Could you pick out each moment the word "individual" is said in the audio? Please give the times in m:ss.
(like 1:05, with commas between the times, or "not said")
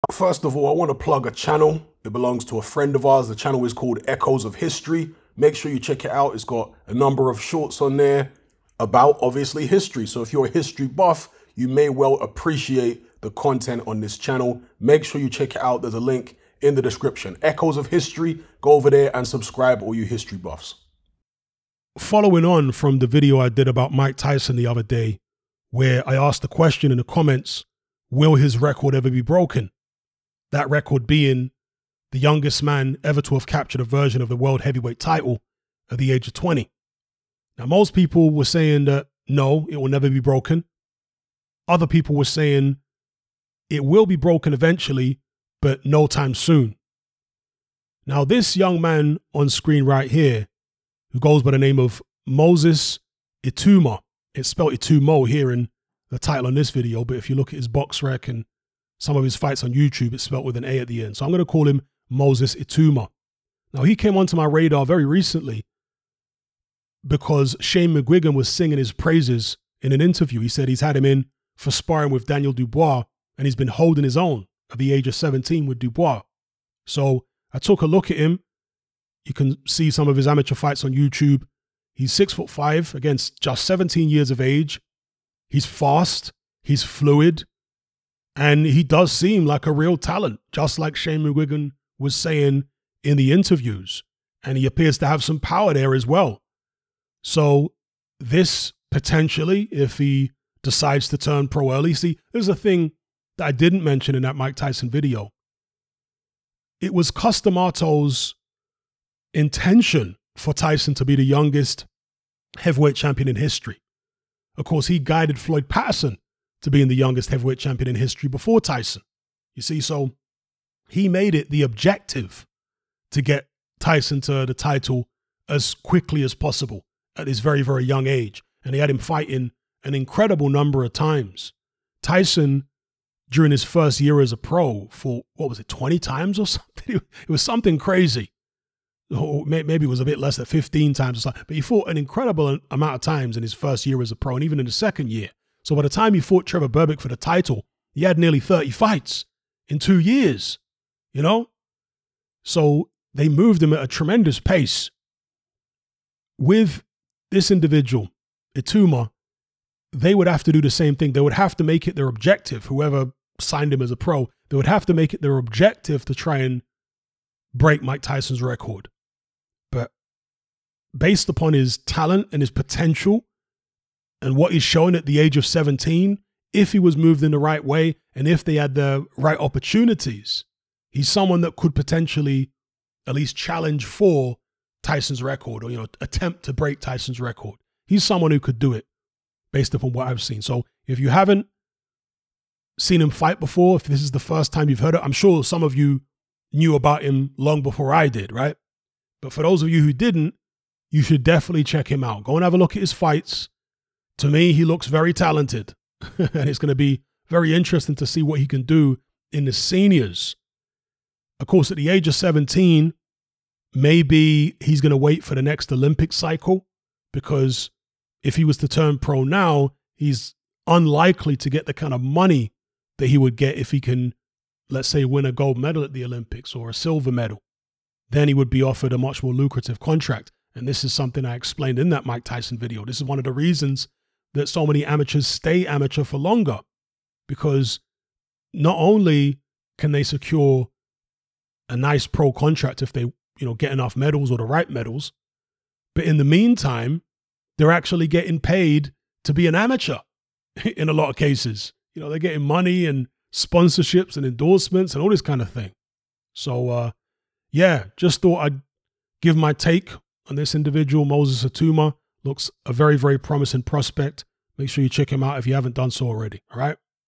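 2:37, 4:20.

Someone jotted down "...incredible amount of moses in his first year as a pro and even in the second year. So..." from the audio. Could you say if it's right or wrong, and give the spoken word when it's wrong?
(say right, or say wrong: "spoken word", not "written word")
wrong: "times", not "moses".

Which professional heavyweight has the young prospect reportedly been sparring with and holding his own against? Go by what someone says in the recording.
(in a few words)
Daniel Dubois.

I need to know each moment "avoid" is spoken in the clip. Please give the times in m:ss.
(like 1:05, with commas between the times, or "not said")
not said.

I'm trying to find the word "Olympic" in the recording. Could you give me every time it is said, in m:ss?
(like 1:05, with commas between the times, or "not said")
3:35, 3:46.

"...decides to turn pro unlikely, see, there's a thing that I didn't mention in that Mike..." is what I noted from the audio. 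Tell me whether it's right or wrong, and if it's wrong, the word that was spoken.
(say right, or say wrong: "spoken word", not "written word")
wrong: "early", not "unlikely".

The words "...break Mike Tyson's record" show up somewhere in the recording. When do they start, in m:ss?
2:47.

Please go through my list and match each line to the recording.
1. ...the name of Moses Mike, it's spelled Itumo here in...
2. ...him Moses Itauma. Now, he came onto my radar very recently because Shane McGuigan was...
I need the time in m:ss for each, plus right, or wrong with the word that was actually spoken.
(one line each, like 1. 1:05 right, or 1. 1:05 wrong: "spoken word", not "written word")
1. 0:51 wrong: "Itauma", not "Mike"
2. 1:01 right.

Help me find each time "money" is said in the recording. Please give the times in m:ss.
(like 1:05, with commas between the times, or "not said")
3:42, 4:12.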